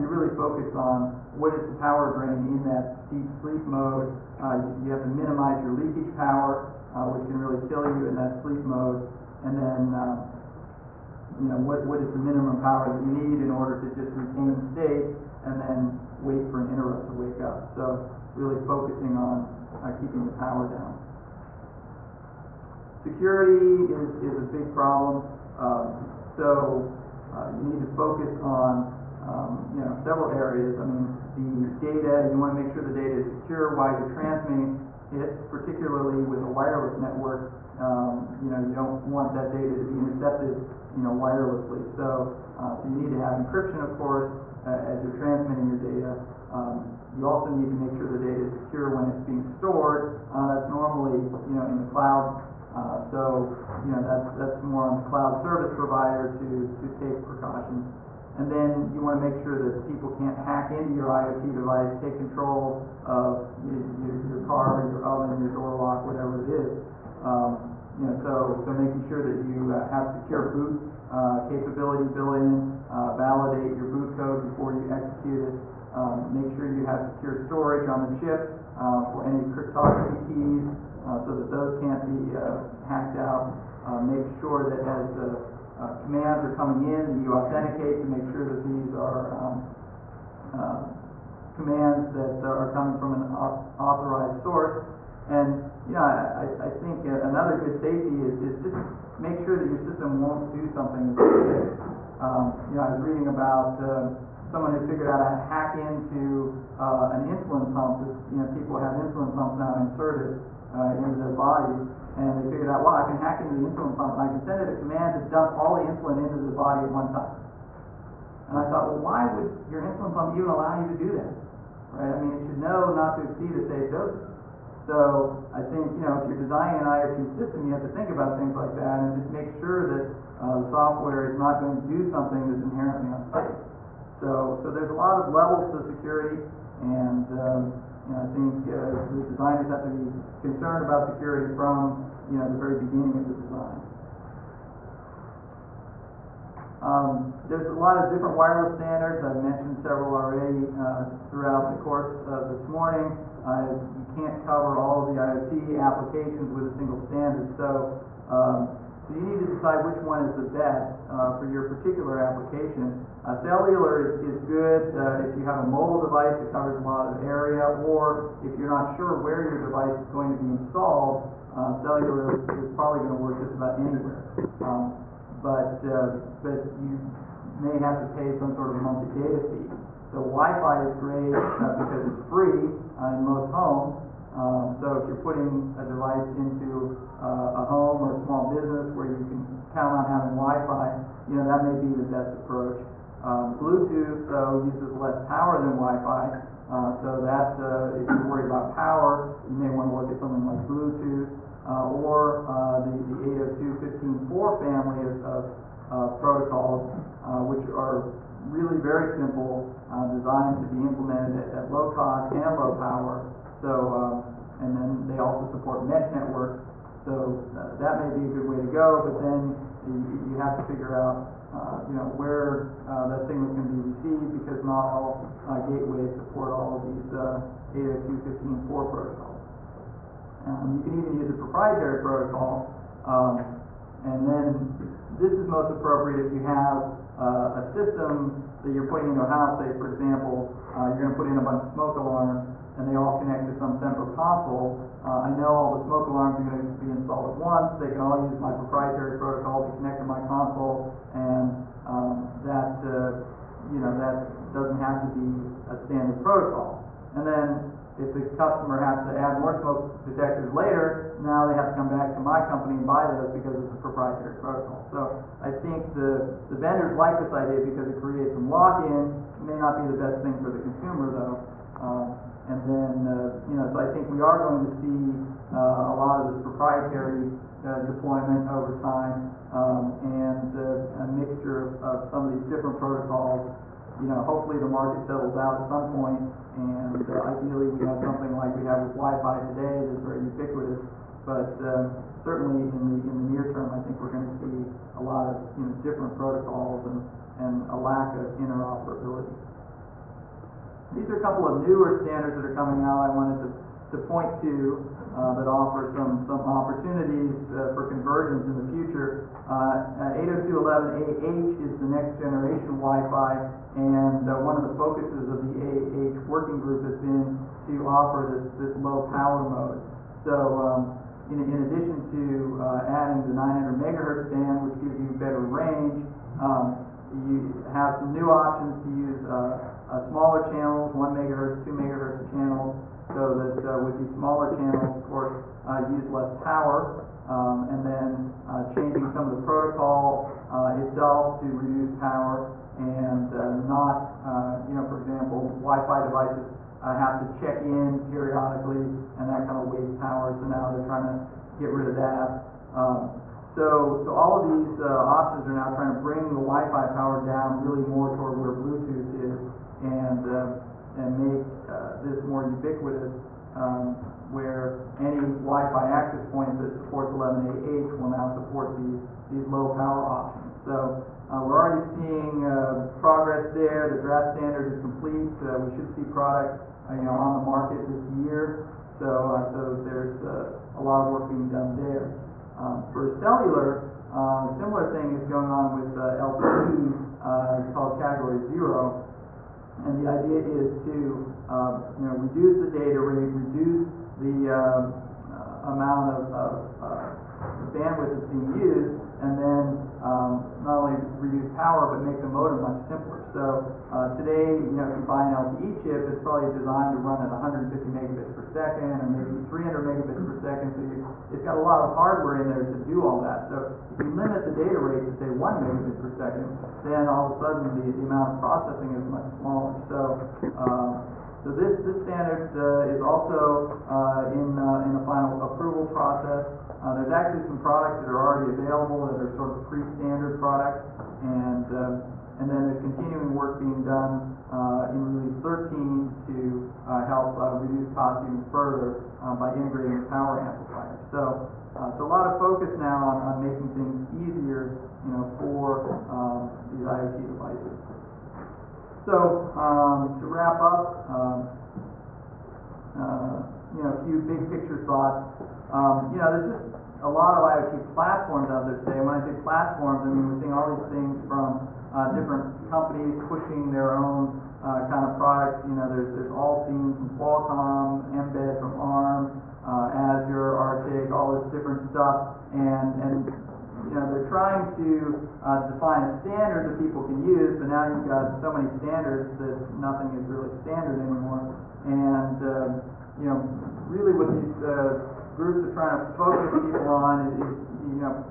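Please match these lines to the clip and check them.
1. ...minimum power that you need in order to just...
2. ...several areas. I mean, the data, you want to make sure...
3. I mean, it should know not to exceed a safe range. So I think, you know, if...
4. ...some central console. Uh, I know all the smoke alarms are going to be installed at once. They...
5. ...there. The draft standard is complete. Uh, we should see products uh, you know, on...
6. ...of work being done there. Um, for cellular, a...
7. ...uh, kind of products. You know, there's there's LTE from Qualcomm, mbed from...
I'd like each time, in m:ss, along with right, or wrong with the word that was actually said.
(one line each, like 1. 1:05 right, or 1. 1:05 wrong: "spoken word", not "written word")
1. 0:12 right
2. 0:29 right
3. 2:02 wrong: "dosage", not "range"
4. 4:03 right
5. 6:13 right
6. 6:21 right
7. 7:44 wrong: "AllSeen", not "LTE".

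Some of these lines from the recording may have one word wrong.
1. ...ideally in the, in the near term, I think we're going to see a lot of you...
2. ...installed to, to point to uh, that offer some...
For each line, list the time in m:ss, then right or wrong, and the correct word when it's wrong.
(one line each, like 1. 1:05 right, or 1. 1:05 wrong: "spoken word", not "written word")
1. 4:52 wrong: "certainly", not "ideally"
2. 5:03 wrong: "wanted", not "installed".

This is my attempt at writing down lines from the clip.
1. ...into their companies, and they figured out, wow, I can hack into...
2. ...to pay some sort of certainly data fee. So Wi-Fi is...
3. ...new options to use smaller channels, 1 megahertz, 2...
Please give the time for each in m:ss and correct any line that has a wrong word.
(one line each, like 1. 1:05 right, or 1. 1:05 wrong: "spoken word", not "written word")
1. 1:50 wrong: "bodies", not "companies"
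2. 2:58 wrong: "monthly", not "certainly"
3. 5:28 right.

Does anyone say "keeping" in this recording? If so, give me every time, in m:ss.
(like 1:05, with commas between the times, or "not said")
0:19.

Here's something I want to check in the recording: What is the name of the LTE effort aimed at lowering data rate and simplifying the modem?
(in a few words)
Category Zero.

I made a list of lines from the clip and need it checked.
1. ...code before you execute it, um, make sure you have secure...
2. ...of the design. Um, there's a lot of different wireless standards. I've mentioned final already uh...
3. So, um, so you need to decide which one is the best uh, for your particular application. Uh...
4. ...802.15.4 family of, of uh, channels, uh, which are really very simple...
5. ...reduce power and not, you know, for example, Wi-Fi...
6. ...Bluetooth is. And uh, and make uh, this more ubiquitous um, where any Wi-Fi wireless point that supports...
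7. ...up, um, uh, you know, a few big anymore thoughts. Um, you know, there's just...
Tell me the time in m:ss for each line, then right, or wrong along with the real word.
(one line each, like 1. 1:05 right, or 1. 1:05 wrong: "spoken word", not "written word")
1. 1:14 right
2. 2:23 wrong: "several", not "final"
3. 2:37 right
4. 3:23 wrong: "protocols", not "channels"
5. 5:41 right
6. 5:58 wrong: "access", not "wireless"
7. 7:30 wrong: "picture", not "anymore".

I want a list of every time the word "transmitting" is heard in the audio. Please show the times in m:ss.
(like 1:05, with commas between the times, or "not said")
0:34, 0:45.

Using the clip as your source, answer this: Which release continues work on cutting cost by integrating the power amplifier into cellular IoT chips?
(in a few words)
Release 13.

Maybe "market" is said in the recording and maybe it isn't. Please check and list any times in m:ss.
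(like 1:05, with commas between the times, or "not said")
4:44, 6:17.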